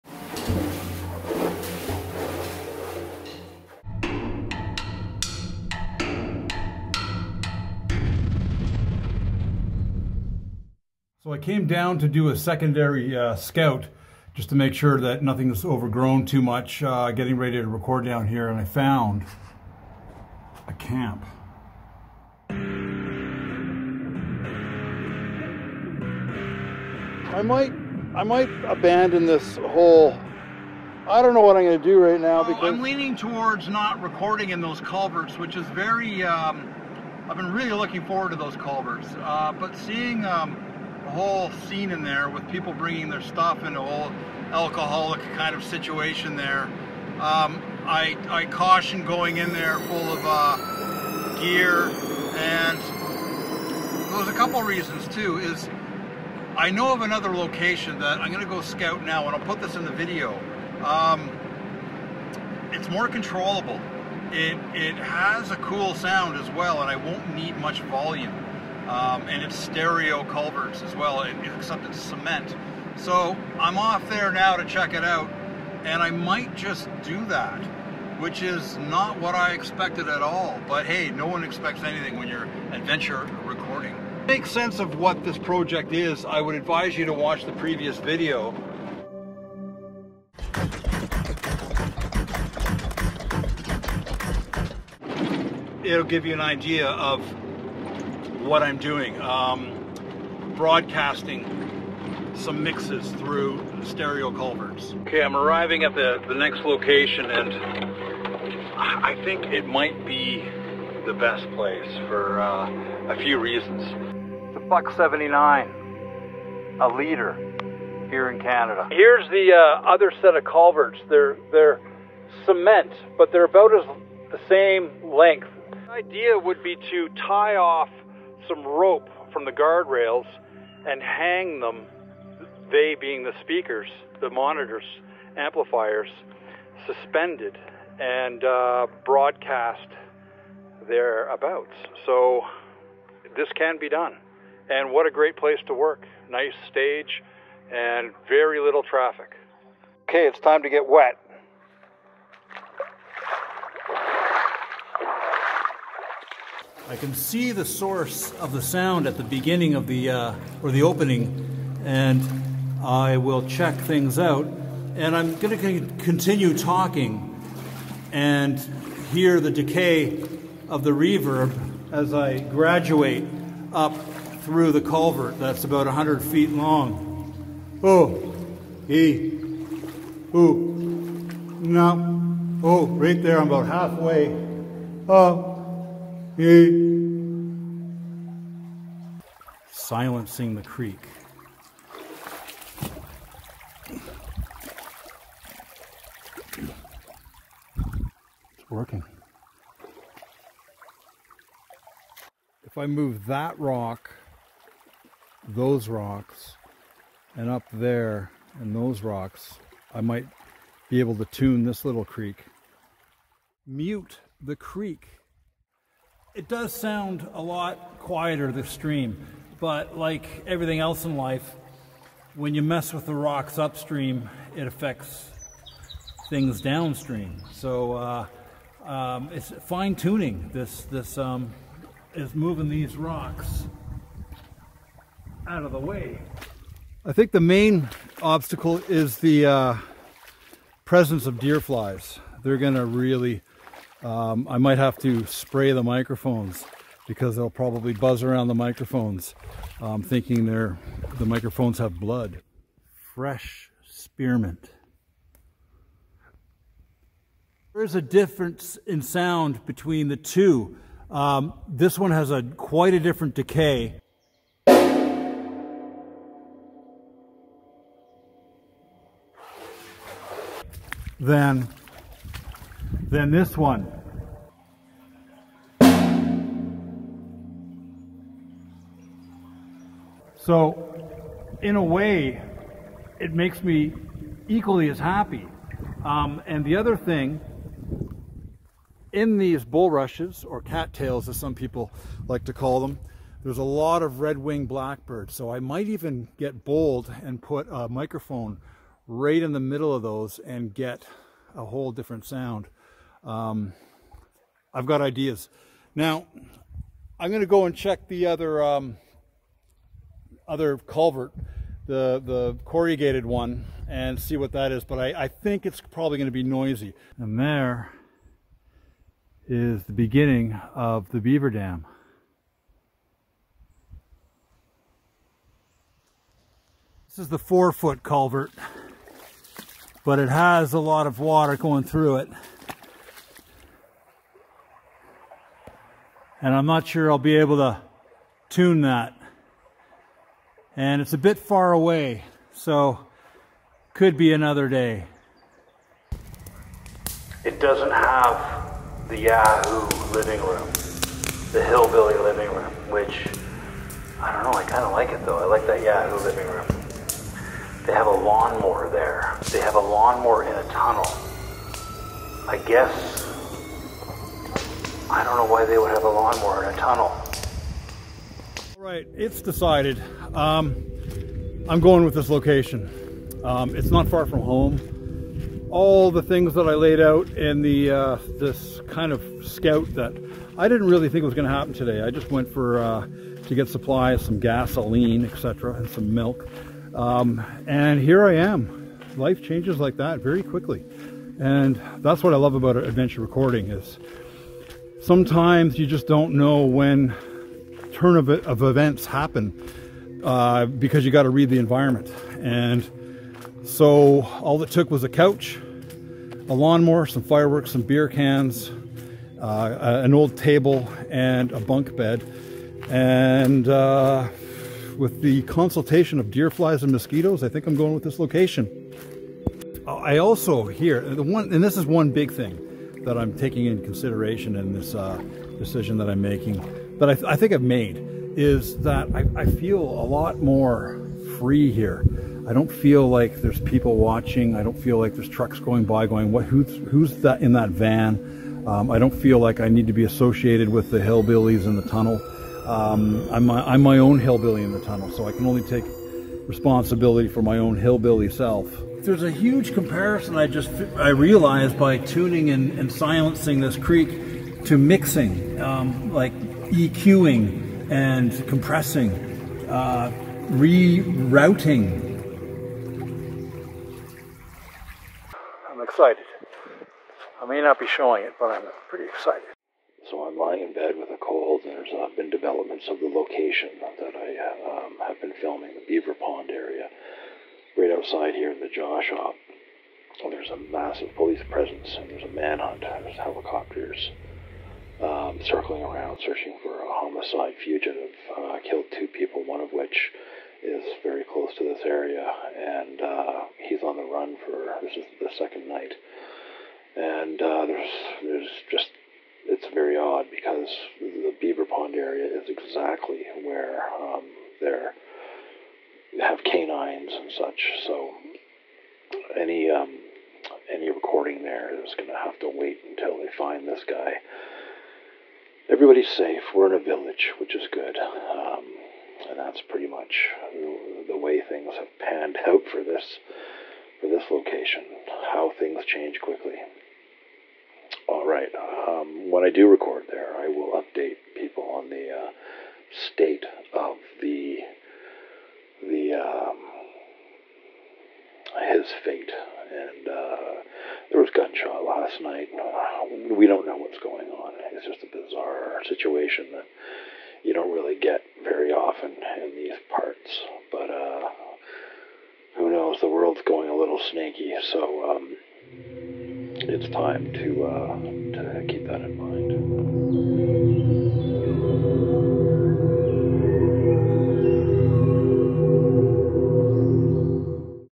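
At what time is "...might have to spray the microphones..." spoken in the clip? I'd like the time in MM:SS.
04:04.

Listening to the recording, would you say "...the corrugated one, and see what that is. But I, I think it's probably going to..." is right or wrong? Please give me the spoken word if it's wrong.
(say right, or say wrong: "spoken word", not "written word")
right.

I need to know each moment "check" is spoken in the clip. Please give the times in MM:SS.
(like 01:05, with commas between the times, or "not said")
01:14, 02:43, 05:07.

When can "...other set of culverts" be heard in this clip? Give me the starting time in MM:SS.
01:59.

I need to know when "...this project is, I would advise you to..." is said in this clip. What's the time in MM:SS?
01:25.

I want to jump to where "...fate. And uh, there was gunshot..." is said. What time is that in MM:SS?
08:59.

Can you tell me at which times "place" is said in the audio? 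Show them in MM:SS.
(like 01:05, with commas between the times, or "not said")
01:51, 02:25.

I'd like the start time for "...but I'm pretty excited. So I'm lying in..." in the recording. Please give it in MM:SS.
07:48.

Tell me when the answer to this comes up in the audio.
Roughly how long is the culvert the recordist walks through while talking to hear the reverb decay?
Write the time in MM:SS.
02:55.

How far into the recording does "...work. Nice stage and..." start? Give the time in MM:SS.
02:25.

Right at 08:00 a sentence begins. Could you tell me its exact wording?
There's a massive police presence, and there's a manhunt.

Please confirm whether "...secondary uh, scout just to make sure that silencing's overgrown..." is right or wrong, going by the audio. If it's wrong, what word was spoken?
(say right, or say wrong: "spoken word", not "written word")
wrong: "nothing", not "silencing".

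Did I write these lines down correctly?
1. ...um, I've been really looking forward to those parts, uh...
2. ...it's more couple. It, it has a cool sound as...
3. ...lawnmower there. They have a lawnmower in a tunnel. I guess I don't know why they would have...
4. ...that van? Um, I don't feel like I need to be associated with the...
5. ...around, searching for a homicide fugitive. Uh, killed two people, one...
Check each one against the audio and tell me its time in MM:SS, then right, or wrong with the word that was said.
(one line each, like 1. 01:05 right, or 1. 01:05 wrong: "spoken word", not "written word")
1. 00:36 wrong: "culverts", not "parts"
2. 01:02 wrong: "controllable", not "couple"
3. 05:58 right
4. 07:17 right
5. 08:05 right.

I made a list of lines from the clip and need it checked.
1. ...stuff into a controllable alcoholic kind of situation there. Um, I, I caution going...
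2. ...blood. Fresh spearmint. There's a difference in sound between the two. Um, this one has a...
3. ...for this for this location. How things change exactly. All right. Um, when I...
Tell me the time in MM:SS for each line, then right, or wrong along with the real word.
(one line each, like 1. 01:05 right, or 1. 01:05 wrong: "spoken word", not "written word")
1. 00:43 wrong: "whole", not "controllable"
2. 04:11 right
3. 08:42 wrong: "quickly", not "exactly".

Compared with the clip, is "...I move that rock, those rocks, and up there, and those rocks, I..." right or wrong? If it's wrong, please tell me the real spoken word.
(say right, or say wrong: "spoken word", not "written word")
right.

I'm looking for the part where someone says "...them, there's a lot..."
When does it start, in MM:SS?
04:52.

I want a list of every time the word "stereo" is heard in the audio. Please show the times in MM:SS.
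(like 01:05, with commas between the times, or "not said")
01:09, 01:43.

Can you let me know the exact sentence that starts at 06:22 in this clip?
I just went for uh, to get supplies, some gasoline, etc., and some milk.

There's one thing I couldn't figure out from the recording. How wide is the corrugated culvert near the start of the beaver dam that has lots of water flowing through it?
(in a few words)
four foot.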